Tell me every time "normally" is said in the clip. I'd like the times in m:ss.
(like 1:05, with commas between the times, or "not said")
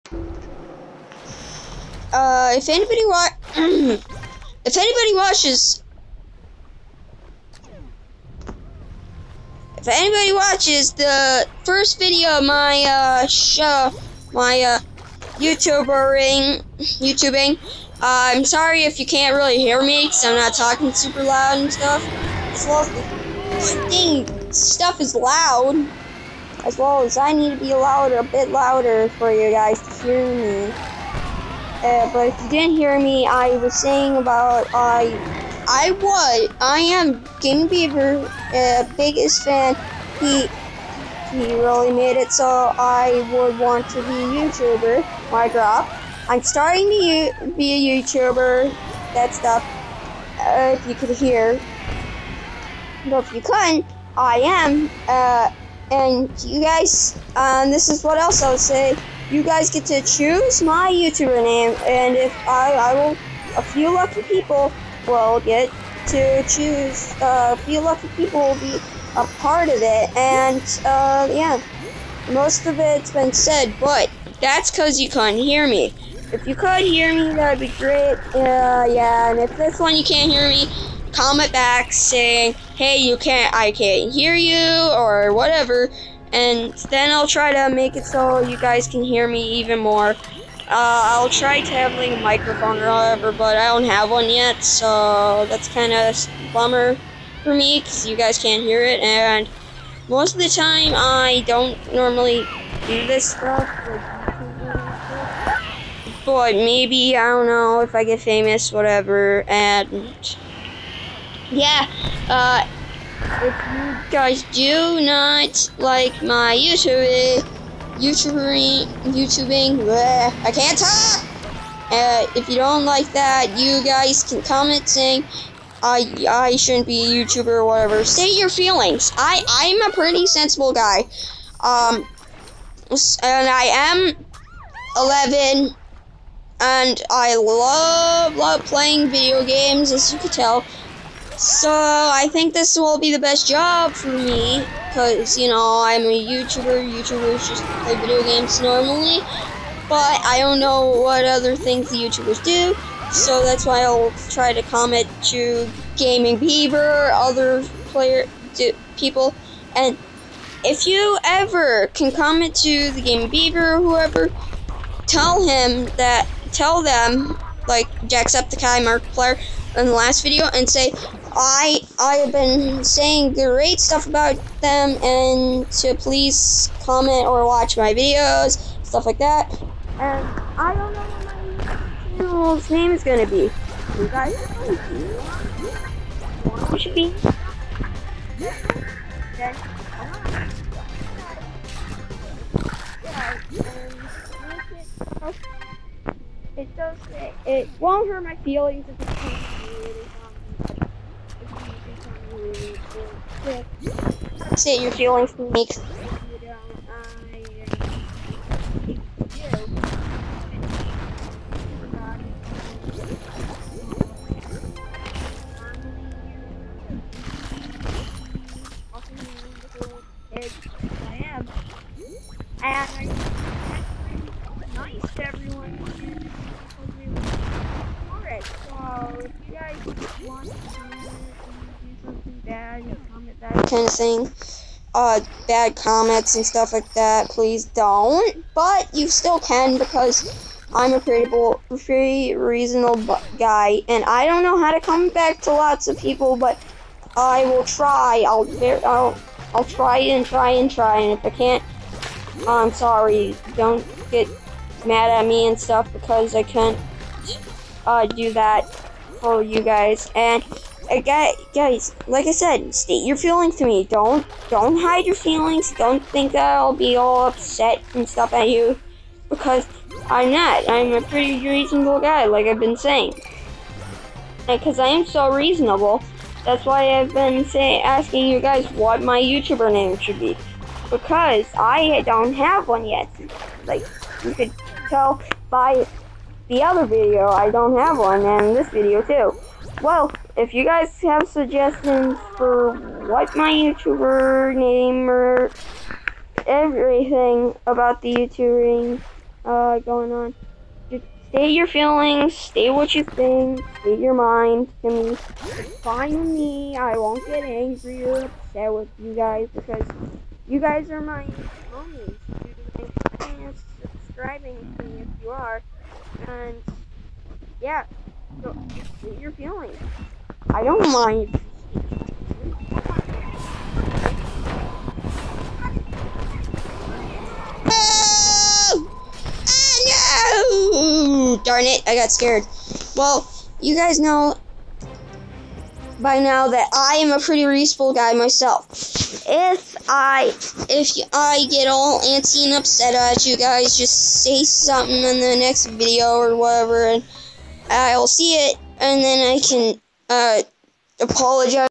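1:41, 2:28.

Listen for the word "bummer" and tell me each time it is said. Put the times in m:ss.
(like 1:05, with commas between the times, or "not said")
1:36.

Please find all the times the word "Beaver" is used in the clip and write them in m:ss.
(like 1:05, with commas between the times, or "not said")
0:37, 2:36, 2:43.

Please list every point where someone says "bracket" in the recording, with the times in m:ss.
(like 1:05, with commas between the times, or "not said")
not said.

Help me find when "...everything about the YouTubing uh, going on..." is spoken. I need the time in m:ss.
4:56.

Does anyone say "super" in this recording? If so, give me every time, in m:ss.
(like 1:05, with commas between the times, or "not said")
0:20.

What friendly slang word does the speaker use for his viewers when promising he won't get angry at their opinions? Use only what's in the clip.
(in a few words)
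homies.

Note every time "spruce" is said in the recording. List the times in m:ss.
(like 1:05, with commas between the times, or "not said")
not said.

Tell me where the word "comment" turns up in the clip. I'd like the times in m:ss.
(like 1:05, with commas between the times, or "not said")
1:21, 2:04, 2:34, 2:42, 2:56, 3:55.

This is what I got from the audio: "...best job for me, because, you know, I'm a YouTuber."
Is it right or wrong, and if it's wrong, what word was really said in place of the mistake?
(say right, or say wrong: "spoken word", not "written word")
right.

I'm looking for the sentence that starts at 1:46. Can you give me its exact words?
But maybe I don't know if I get famous, whatever.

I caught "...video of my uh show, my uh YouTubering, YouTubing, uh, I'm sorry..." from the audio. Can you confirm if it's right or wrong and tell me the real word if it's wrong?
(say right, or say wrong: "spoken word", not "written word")
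right.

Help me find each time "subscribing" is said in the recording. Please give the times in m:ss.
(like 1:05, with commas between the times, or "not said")
5:14.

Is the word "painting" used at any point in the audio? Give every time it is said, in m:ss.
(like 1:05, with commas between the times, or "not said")
not said.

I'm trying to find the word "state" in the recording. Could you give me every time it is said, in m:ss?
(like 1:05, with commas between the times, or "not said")
4:22, 5:19.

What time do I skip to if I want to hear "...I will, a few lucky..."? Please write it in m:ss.
1:02.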